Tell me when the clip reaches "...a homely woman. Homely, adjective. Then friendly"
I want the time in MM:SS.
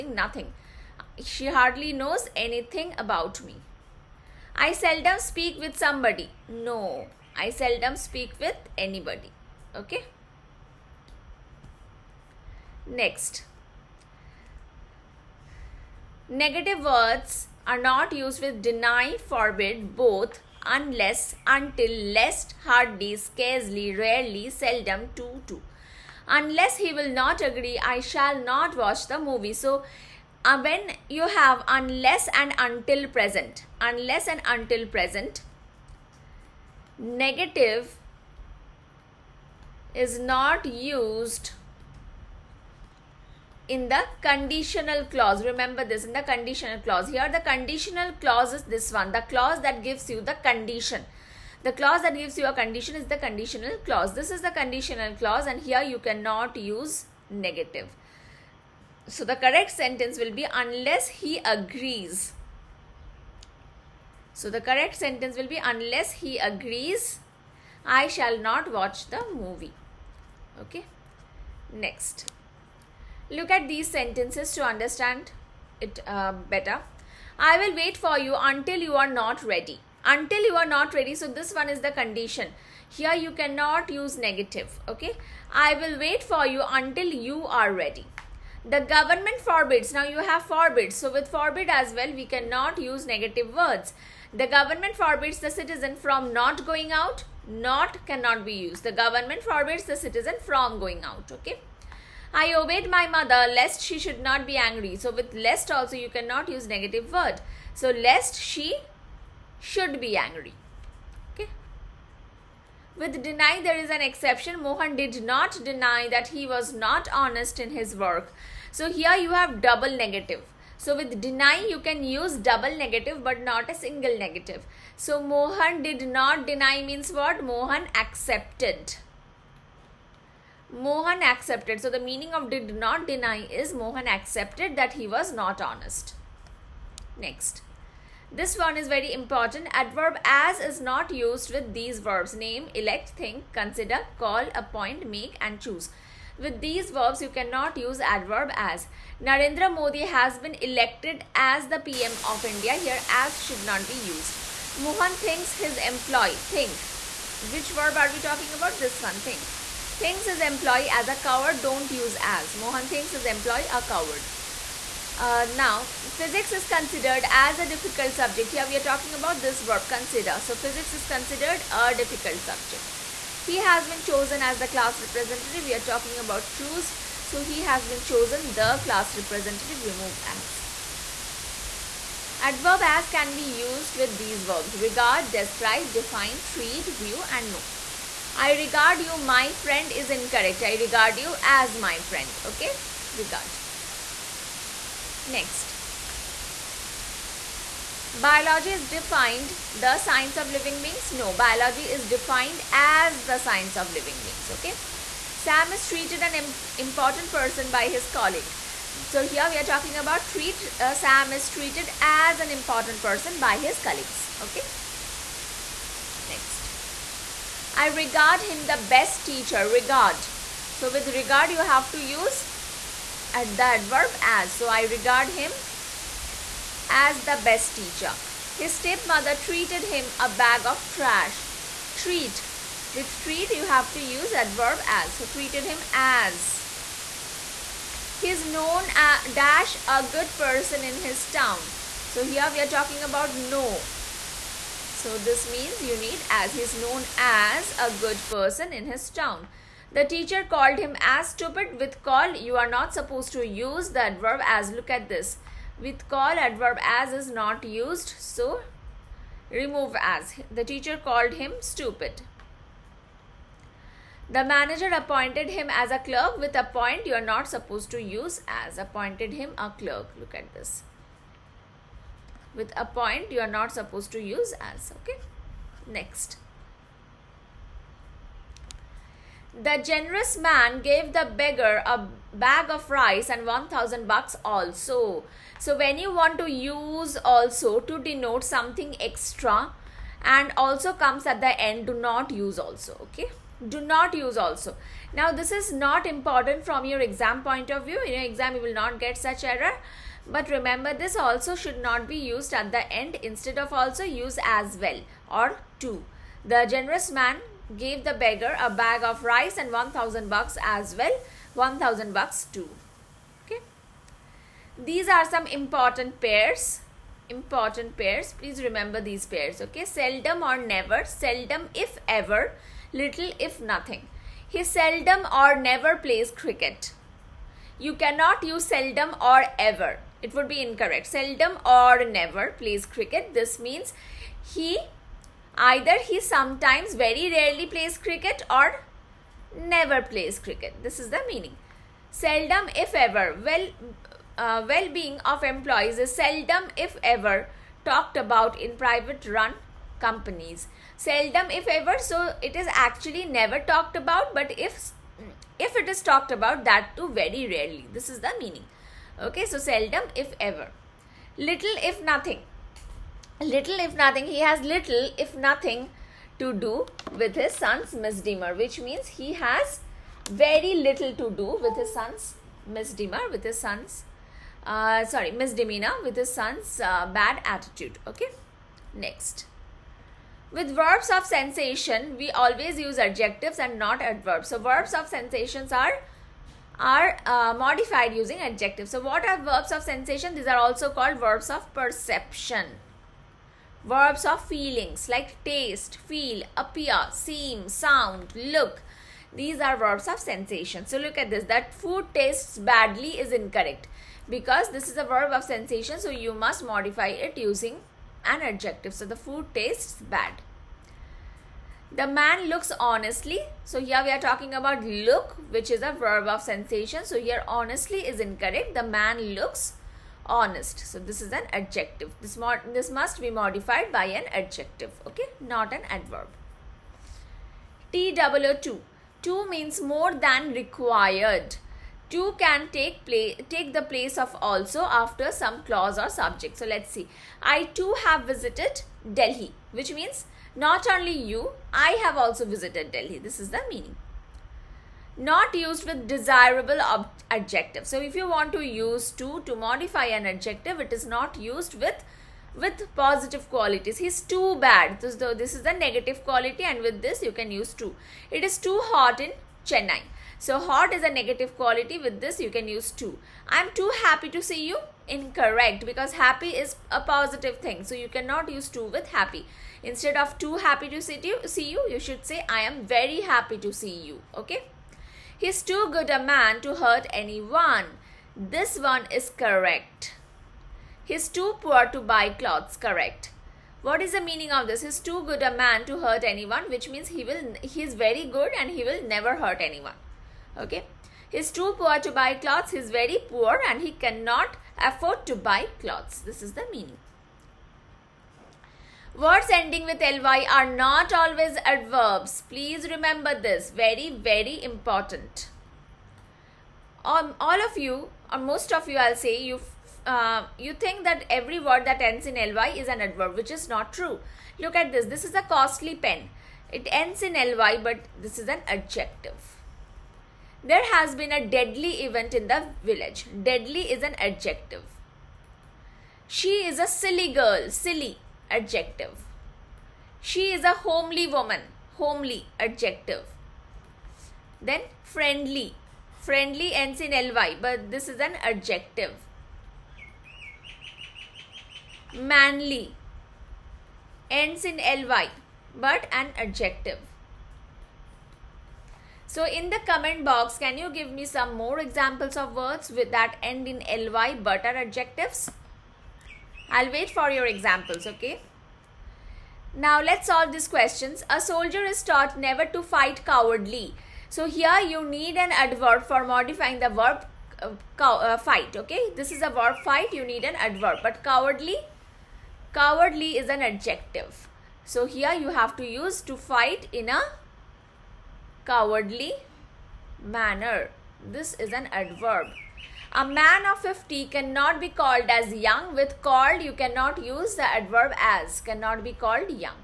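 08:50.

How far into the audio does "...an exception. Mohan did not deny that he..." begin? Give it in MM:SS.
01:53.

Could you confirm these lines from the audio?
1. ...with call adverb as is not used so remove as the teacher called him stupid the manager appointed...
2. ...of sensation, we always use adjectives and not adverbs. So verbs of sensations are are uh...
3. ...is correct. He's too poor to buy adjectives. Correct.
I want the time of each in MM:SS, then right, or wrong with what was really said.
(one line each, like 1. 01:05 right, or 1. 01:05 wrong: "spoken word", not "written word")
1. 04:15 right
2. 06:21 right
3. 07:59 wrong: "clothes", not "adjectives".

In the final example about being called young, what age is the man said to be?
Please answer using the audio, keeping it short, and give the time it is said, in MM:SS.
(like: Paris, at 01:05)
50, at 09:43.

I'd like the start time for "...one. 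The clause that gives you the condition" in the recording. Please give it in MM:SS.
00:48.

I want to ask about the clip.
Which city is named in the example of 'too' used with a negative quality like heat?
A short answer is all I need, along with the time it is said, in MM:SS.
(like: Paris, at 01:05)
Chennai, at 07:39.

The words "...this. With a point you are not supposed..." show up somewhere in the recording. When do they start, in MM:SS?
04:30.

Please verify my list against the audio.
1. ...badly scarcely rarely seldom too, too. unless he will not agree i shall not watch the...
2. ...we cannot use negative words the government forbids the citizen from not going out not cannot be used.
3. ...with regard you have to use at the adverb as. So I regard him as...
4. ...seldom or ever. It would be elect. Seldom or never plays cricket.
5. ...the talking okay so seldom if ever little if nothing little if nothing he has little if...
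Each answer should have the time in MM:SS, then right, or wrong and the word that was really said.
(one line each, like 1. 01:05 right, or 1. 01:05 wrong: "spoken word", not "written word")
1. 00:22 wrong: "hardly", not "badly"
2. 01:32 right
3. 03:40 right
4. 05:28 wrong: "incorrect", not "elect"
5. 05:58 wrong: "meaning", not "talking".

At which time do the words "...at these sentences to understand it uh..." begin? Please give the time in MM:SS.
01:13.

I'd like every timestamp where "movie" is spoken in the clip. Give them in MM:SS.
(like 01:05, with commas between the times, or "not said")
00:29, 01:09.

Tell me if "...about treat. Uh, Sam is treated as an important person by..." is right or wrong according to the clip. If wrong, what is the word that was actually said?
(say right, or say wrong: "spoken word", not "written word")
right.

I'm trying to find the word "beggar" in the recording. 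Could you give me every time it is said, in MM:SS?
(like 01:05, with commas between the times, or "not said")
04:41, 05:08.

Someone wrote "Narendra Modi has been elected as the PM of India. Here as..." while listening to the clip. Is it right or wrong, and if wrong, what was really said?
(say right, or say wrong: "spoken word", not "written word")
right.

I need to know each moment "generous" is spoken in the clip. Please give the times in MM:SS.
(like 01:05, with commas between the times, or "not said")
04:39, 05:06.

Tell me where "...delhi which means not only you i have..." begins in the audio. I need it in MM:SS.
07:19.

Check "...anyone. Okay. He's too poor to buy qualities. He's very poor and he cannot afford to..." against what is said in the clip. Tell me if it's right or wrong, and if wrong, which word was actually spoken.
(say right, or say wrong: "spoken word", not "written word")
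wrong: "clothes", not "qualities".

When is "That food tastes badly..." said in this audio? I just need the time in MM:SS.
06:41.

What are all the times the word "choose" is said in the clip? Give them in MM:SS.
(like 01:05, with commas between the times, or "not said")
02:25, 02:56.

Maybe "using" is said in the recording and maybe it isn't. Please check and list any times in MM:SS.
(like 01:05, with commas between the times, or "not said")
06:28, 06:47.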